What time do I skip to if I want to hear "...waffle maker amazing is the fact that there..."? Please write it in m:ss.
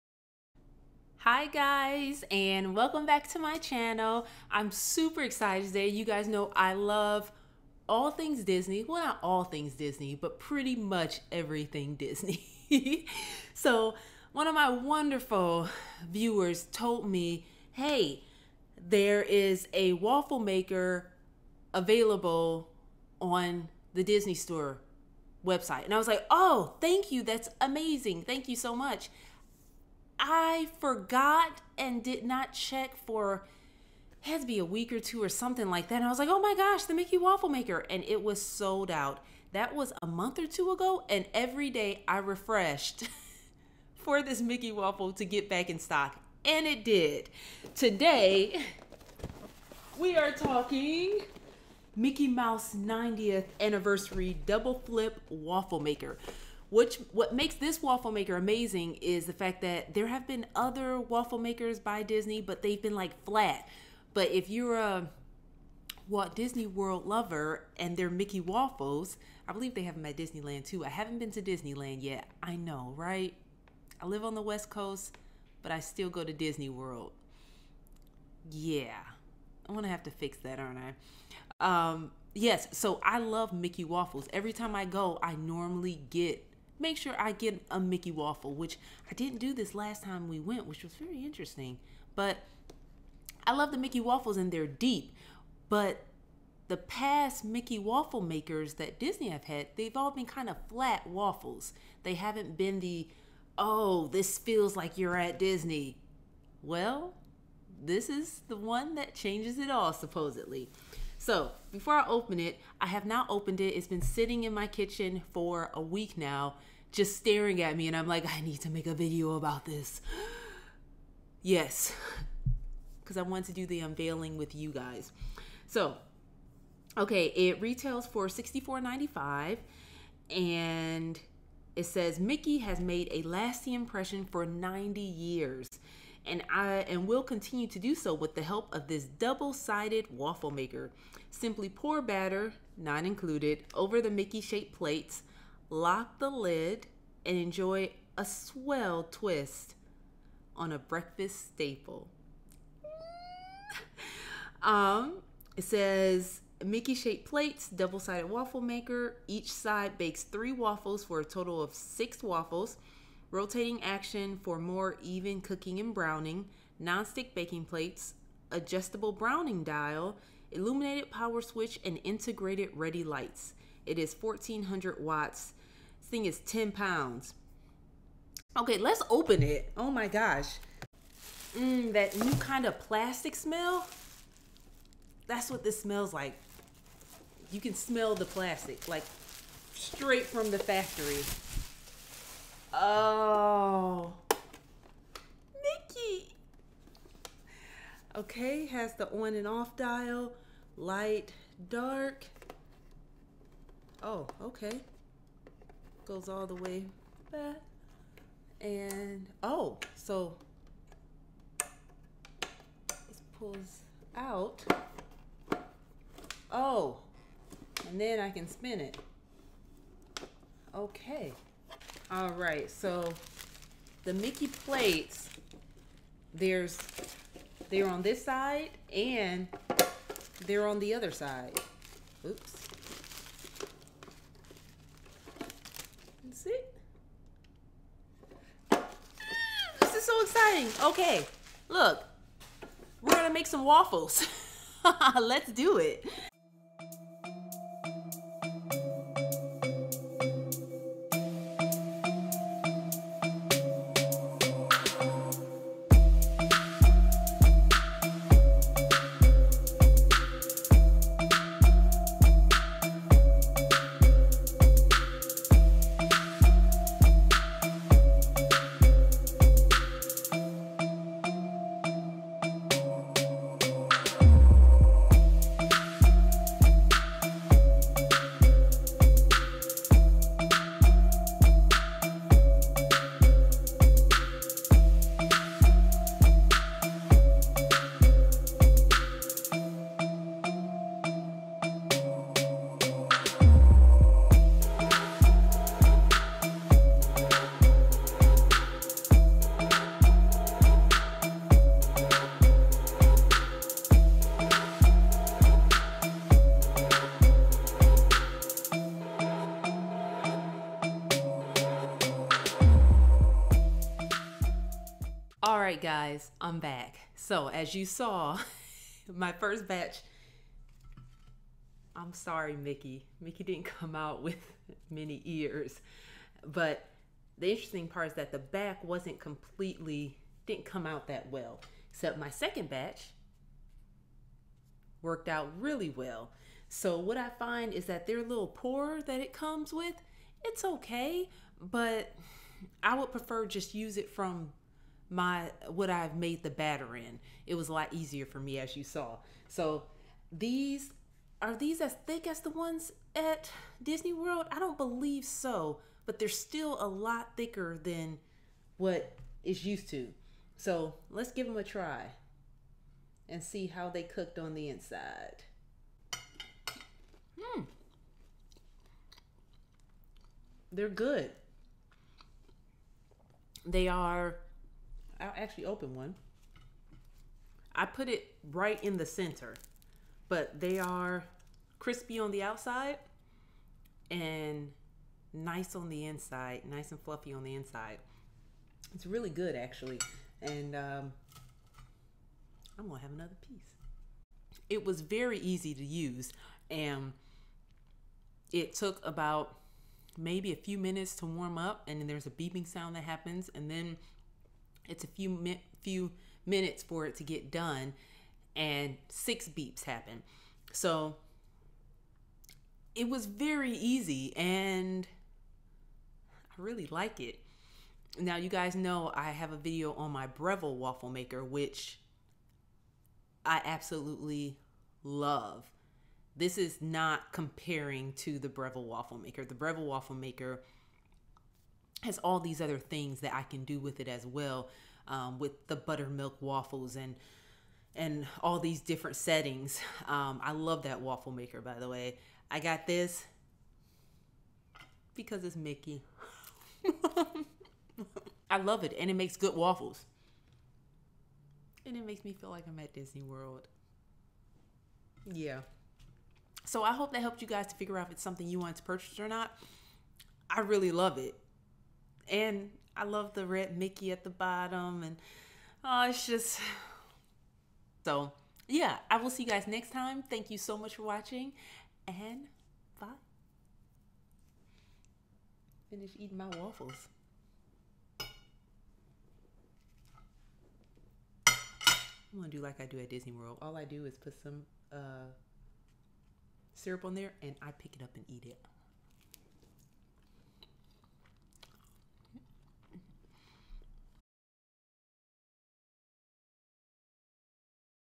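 0:57.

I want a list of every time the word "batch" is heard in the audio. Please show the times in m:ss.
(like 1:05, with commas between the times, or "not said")
5:19, 5:32.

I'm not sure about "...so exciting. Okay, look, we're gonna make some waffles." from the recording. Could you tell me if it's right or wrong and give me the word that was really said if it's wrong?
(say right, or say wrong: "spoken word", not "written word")
right.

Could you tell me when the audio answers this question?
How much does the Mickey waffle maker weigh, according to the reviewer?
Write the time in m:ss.
2:56.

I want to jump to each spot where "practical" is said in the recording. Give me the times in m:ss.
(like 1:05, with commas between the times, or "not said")
not said.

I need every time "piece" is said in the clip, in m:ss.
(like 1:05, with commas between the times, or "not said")
6:33.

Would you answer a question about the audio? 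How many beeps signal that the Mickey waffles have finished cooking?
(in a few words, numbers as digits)
6.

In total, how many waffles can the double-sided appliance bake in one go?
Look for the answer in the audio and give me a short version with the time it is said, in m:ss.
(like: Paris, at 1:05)
6, at 2:41.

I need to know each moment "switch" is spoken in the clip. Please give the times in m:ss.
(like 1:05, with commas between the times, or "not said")
2:51.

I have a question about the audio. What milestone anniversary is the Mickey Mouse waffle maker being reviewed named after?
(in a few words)
90th.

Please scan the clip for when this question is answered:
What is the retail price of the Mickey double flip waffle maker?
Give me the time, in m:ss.
2:08.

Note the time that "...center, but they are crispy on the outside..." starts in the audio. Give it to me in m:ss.
6:19.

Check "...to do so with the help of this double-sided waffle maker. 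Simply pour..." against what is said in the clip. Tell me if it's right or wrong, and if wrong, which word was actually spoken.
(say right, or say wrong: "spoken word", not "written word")
right.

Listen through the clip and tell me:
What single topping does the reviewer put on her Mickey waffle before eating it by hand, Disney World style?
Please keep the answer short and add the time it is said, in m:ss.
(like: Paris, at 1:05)
Syrup, at 8:06.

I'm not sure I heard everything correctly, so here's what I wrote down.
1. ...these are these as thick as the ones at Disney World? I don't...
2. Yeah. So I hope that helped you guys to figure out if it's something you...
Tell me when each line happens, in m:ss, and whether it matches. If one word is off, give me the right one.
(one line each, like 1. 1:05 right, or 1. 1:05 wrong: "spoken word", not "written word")
1. 5:50 right
2. 7:35 right.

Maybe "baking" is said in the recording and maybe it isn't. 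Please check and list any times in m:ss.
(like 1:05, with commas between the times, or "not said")
2:47.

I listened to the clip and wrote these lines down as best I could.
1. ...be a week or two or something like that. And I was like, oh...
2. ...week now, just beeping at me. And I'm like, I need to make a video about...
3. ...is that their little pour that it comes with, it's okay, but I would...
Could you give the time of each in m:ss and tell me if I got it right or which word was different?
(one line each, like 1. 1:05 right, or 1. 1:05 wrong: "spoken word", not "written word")
1. 0:34 right
2. 1:55 wrong: "staring", not "beeping"
3. 5:37 right.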